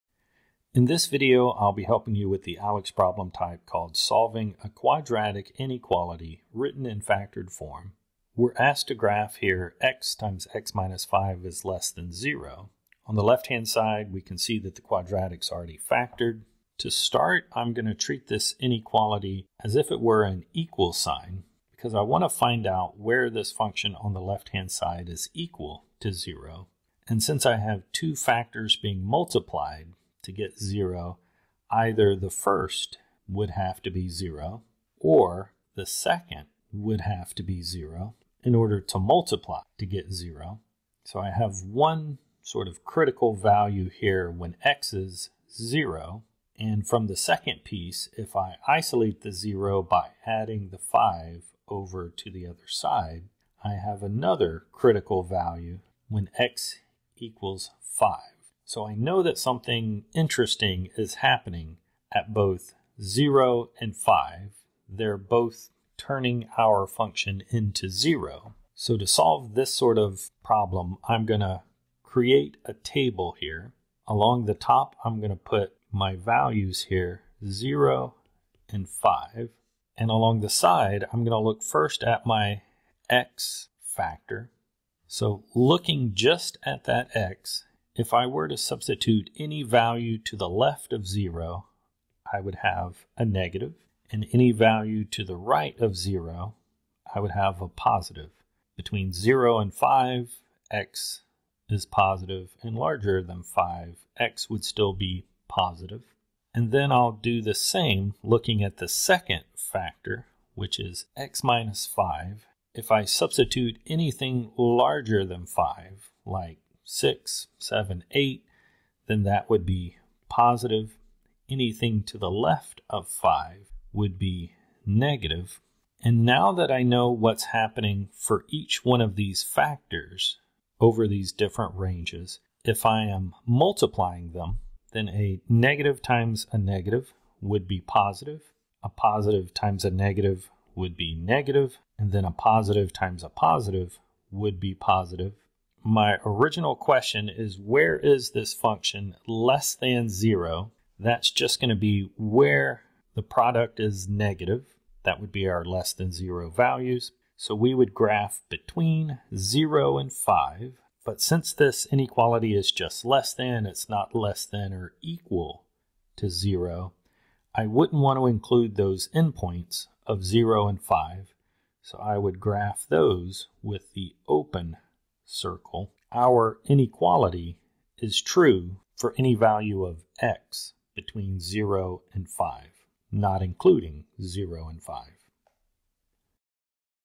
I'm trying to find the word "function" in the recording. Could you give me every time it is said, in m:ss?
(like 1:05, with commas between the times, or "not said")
0:23, 1:06, 2:28.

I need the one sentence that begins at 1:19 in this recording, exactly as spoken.
And along the side, I'm going to look first at my x factor.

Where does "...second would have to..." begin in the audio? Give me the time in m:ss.
0:35.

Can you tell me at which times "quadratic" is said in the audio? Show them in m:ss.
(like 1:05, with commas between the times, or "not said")
0:04, 0:14.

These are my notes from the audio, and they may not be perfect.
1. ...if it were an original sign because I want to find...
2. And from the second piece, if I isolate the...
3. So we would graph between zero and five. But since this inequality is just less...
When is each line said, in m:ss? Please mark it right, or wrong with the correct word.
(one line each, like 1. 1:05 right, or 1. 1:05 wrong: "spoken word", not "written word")
1. 0:19 wrong: "equal", not "original"
2. 0:46 right
3. 2:37 right.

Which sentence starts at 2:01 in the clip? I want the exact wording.
Anything to the left of five would be negative.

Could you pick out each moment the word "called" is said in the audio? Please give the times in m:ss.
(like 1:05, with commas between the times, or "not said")
0:03.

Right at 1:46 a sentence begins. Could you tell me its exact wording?
And then I'll do the same looking at the second factor, which is x minus 5.